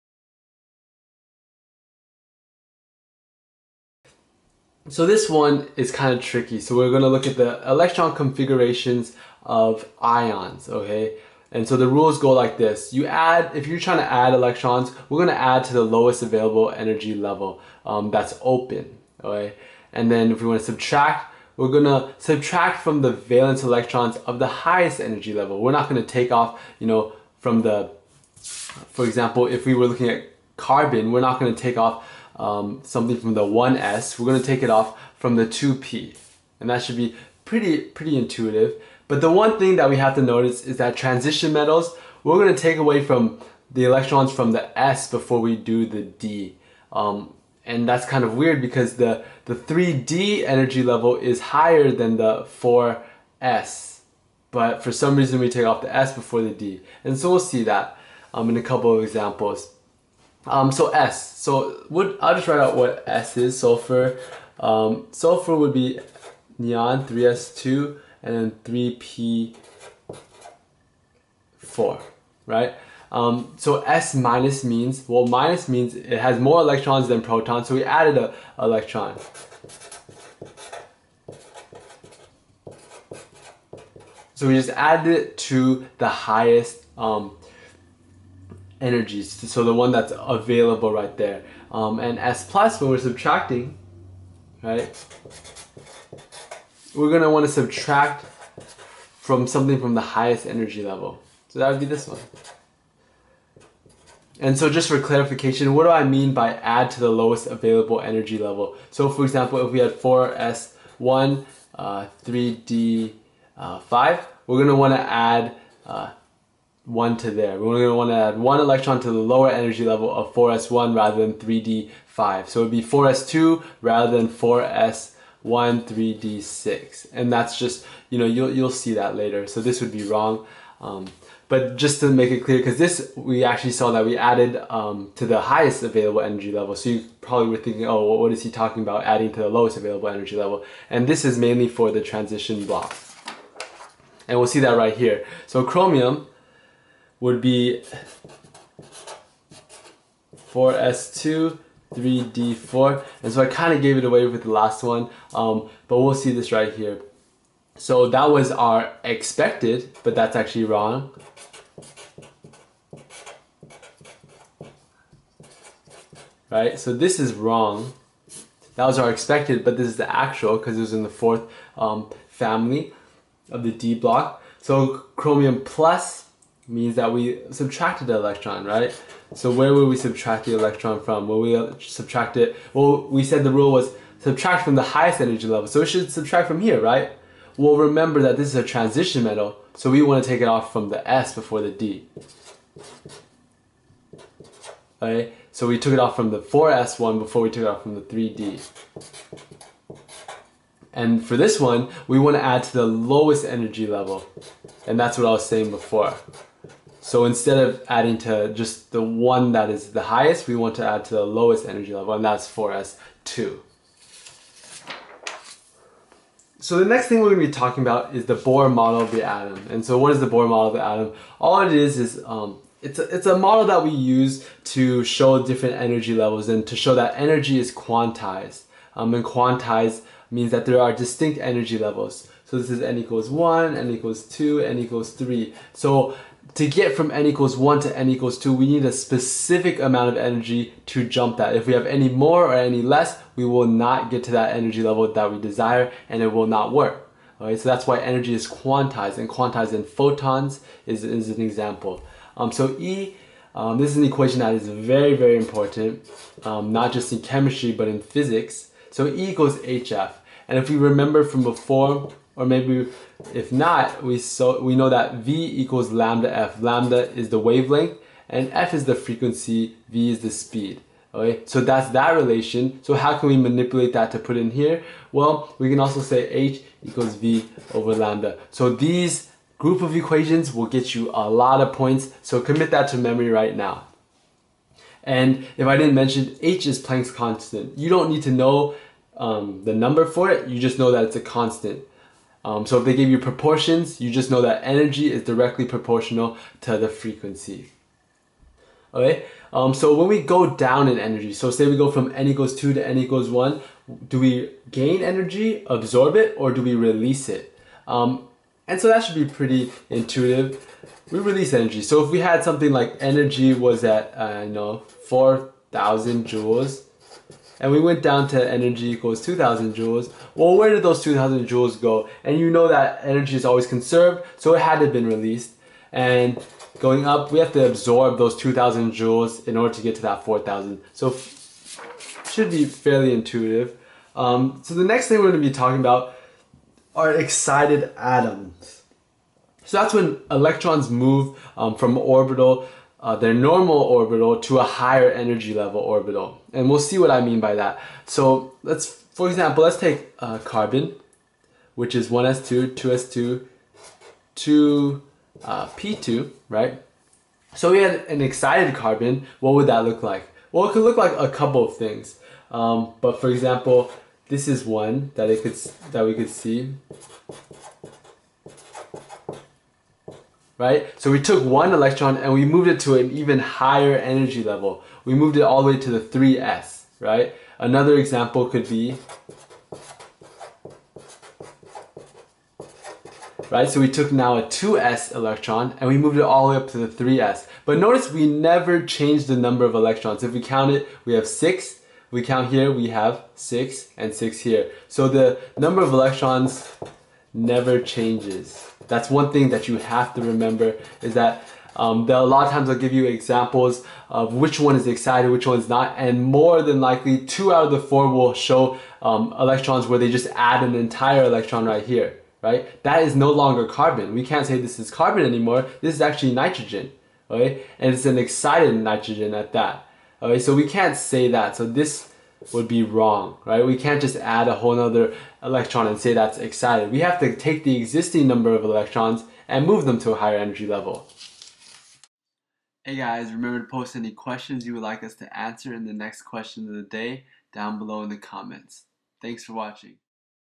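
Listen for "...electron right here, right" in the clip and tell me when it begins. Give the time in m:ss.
6:51.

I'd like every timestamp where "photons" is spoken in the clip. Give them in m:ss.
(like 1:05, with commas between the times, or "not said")
4:09.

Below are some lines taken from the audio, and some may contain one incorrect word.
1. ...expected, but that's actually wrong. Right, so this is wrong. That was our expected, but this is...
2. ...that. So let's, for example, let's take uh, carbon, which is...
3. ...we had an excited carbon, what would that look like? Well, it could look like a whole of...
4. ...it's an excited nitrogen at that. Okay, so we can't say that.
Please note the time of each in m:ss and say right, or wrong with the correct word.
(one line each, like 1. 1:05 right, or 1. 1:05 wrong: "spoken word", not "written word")
1. 2:39 right
2. 5:47 right
3. 5:57 wrong: "couple", not "whole"
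4. 6:57 right.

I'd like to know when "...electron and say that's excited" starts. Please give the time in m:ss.
7:05.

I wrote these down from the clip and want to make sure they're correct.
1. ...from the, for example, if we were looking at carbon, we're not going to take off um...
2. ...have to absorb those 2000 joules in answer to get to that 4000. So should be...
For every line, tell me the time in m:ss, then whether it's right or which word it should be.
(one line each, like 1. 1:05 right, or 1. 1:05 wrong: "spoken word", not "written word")
1. 0:27 right
2. 5:27 wrong: "order", not "answer".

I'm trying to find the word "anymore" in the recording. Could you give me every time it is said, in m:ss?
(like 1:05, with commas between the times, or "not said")
6:55.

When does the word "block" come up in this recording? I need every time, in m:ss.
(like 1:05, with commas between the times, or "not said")
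2:22, 2:53.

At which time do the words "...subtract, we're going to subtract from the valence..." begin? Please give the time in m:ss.
0:20.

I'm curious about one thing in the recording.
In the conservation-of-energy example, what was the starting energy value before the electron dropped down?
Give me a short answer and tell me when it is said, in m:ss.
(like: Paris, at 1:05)
4,000 joules, at 5:15.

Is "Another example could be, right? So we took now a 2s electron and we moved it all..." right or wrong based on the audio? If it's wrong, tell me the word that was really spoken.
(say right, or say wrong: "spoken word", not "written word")
right.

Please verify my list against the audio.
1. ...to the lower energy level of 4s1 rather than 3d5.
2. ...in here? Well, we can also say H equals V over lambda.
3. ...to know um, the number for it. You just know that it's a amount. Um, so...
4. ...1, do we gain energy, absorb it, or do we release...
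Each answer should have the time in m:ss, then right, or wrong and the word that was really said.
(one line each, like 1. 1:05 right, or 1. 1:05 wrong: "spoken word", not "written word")
1. 1:59 right
2. 4:34 right
3. 4:48 wrong: "constant", not "amount"
4. 5:03 right.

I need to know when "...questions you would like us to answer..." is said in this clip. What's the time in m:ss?
7:14.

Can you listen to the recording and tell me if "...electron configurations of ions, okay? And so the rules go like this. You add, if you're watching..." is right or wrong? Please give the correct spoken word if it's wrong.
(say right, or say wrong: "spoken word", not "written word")
wrong: "trying", not "watching".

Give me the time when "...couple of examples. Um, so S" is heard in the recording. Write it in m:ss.
0:58.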